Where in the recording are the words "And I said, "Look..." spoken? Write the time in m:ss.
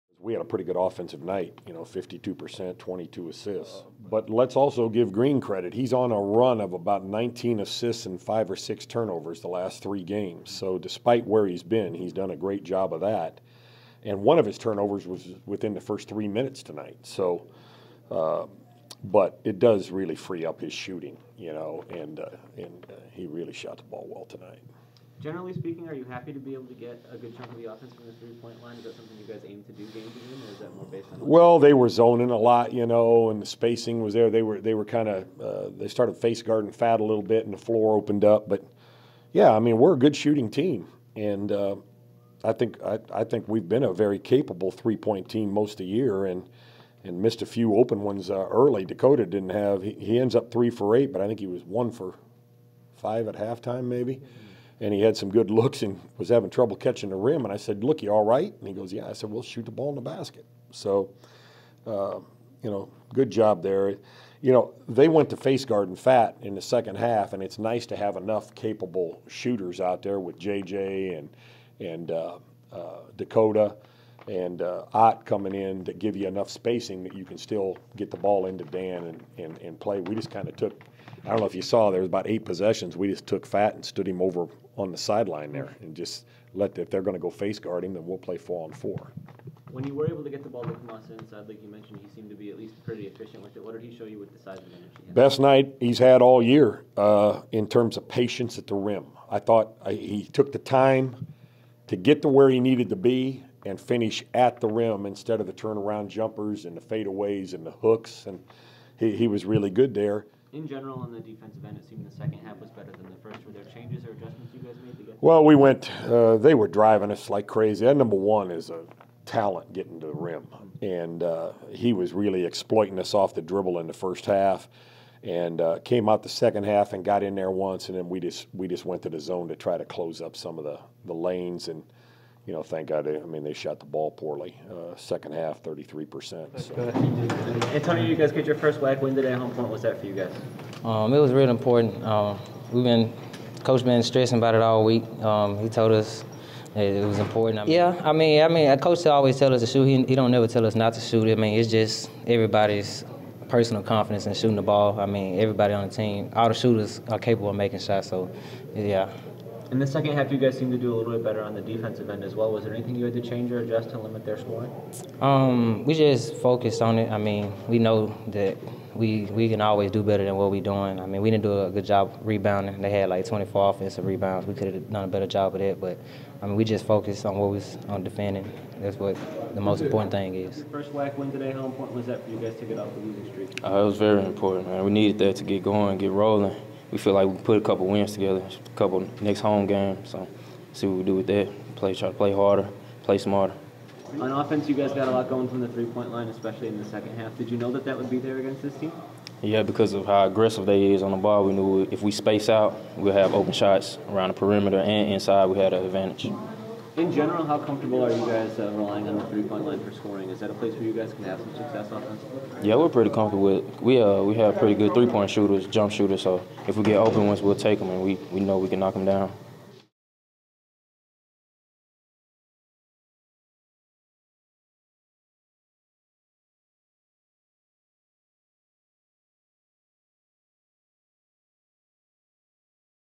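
0:57.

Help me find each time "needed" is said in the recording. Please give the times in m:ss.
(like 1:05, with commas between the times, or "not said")
1:42, 3:04.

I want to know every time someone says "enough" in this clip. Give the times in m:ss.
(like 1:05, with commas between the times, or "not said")
1:08, 1:16.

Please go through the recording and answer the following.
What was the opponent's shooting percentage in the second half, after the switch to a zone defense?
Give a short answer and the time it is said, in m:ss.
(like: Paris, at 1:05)
33%, at 2:15.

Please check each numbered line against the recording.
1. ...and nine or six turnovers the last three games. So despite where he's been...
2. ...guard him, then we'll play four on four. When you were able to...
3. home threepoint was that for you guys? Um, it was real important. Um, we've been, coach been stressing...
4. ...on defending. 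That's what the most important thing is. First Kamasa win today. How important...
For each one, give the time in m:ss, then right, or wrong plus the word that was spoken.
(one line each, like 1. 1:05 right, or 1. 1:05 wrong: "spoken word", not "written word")
1. 0:08 wrong: "five", not "nine"
2. 1:27 right
3. 2:19 wrong: "important", not "threepoint"
4. 2:57 wrong: "WAC", not "Kamasa".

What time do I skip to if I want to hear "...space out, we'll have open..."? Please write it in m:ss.
3:22.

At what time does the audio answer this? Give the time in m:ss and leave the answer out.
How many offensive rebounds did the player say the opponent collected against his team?
2:53.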